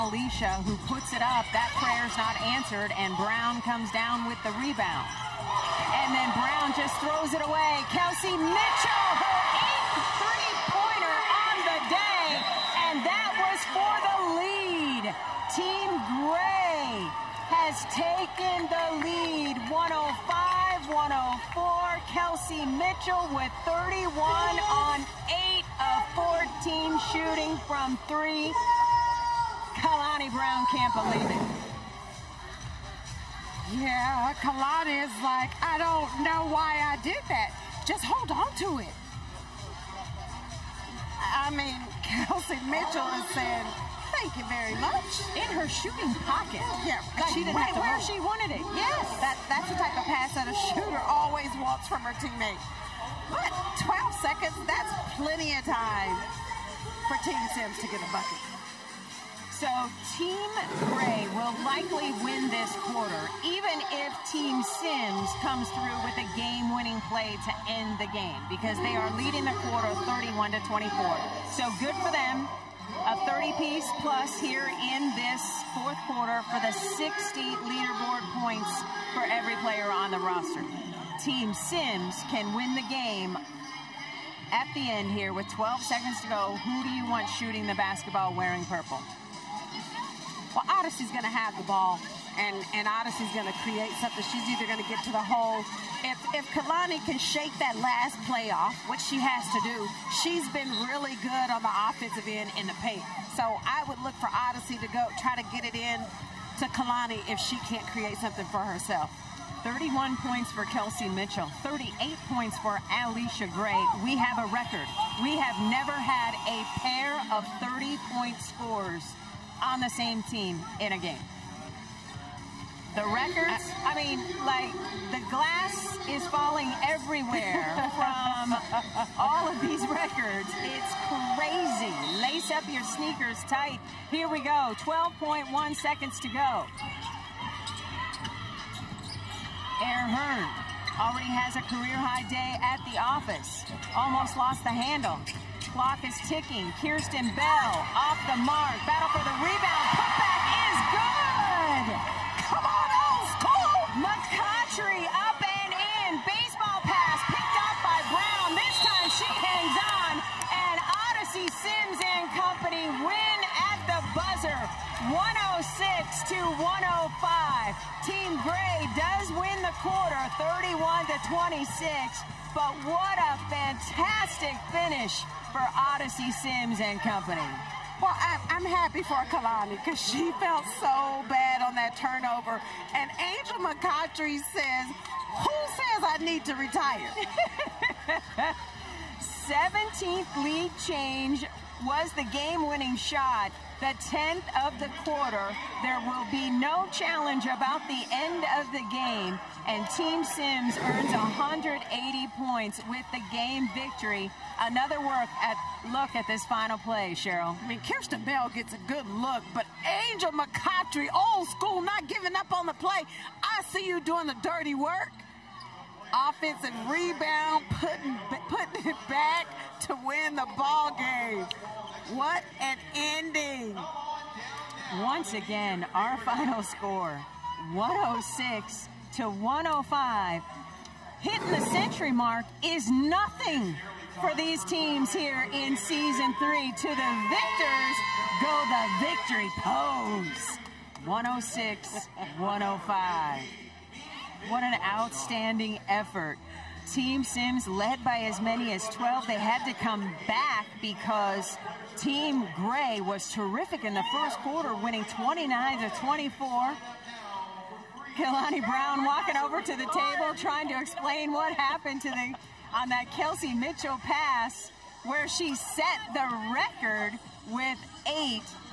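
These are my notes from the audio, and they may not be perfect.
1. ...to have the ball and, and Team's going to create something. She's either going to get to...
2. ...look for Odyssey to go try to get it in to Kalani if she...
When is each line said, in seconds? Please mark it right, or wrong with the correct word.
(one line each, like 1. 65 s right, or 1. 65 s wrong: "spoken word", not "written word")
1. 91 s wrong: "Odyssey", not "Team"
2. 104 s right.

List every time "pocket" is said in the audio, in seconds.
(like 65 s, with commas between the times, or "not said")
46 s.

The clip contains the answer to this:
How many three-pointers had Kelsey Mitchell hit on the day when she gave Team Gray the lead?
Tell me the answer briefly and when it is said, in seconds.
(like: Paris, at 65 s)
8, at 9 s.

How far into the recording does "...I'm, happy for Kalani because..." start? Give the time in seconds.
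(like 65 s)
178 s.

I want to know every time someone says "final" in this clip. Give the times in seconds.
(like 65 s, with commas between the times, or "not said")
206 s, 226 s.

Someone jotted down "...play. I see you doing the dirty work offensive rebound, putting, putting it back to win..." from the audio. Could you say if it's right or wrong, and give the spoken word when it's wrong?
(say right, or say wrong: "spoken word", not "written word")
right.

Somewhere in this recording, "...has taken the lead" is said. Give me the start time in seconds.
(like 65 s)
17 s.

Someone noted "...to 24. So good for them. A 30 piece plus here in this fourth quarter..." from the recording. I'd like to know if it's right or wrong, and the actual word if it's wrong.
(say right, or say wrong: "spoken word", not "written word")
right.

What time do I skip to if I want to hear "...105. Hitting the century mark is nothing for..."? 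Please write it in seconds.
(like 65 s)
229 s.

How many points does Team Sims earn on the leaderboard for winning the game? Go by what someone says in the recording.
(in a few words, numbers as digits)
180.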